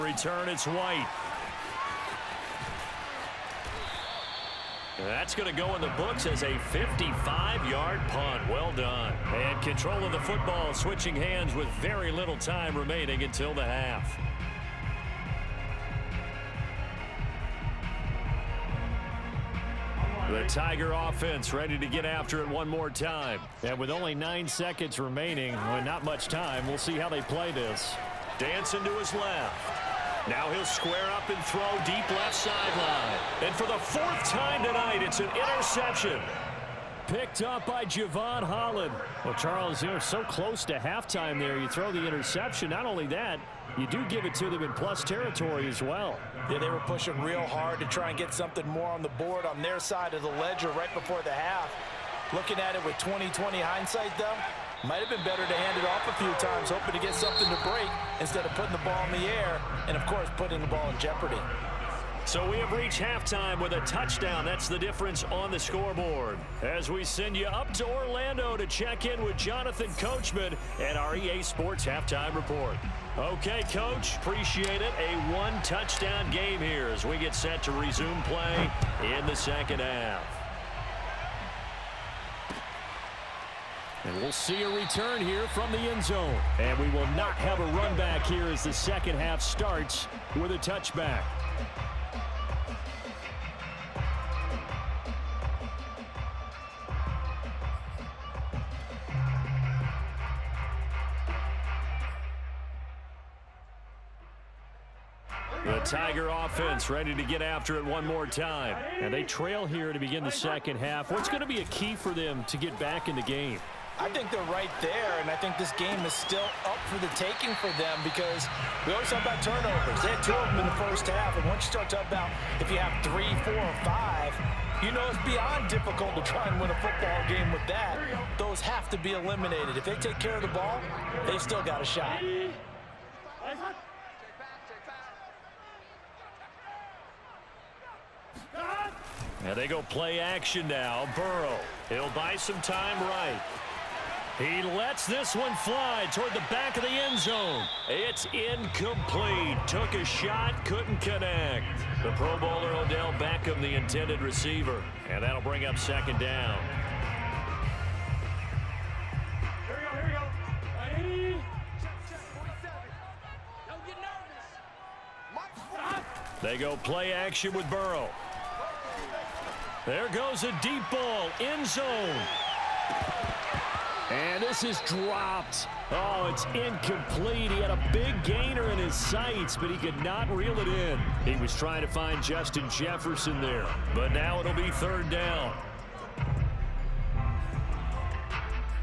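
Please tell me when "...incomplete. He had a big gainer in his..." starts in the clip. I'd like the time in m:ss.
2:56.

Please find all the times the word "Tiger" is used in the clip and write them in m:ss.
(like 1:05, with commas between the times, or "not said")
0:20, 1:45.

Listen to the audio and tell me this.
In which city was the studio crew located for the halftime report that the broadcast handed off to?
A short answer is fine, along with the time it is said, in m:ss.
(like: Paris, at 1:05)
Orlando, at 1:07.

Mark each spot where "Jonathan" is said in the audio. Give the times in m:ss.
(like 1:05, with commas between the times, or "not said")
1:09.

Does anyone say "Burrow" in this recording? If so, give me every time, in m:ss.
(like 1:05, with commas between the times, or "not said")
2:21, 2:47.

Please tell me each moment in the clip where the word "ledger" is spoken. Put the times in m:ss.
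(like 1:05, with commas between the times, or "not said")
0:50.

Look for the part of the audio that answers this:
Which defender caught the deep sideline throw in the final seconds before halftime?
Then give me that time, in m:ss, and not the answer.
0:37.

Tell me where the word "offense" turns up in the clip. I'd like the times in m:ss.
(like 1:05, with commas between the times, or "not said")
0:20, 1:46.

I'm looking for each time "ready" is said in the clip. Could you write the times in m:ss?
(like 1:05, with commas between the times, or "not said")
0:21, 1:46.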